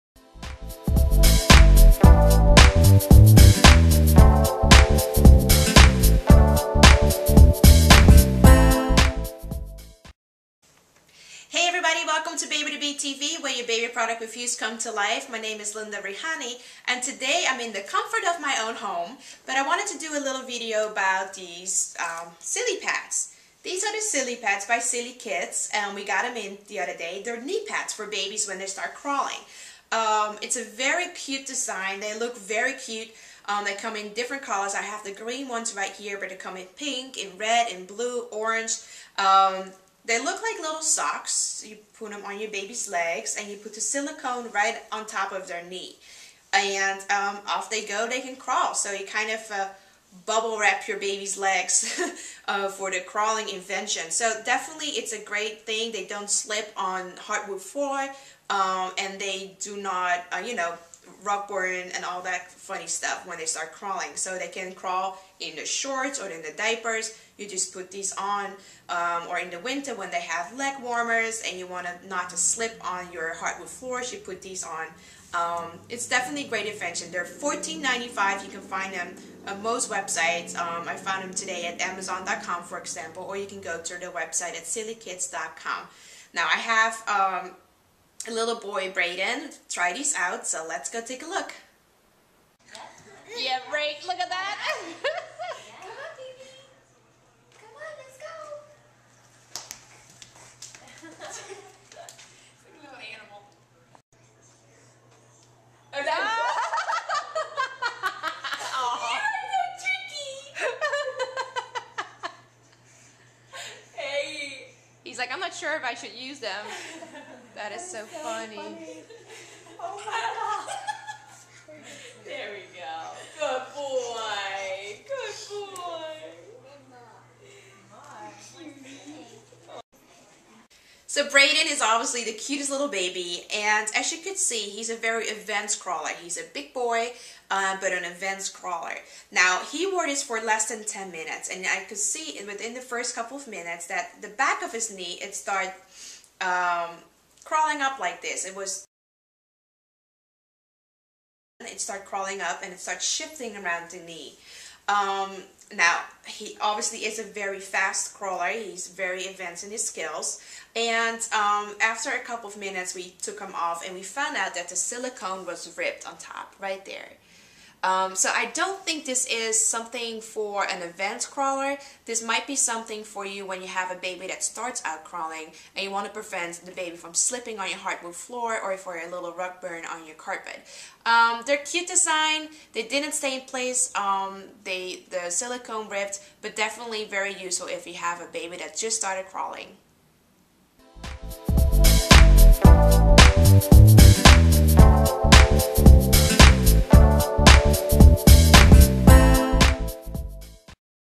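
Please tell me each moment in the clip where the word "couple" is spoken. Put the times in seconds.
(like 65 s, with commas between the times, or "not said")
143 s, 162 s.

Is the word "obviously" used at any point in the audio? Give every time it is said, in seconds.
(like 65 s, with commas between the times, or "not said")
131 s, 156 s.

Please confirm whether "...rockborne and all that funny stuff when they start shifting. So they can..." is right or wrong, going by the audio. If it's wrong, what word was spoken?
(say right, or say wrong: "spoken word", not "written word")
wrong: "crawling", not "shifting".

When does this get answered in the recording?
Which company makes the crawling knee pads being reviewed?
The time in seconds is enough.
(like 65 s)
24 s.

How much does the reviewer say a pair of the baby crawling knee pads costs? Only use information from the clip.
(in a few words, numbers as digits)
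$14.95.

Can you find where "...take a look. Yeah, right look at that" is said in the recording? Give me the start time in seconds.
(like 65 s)
91 s.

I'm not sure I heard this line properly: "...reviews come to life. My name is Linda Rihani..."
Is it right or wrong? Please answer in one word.
right.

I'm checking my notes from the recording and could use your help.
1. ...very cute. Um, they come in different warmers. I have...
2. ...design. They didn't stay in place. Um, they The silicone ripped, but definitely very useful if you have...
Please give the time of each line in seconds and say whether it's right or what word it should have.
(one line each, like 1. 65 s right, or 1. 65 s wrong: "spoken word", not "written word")
1. 32 s wrong: "colors", not "warmers"
2. 181 s right.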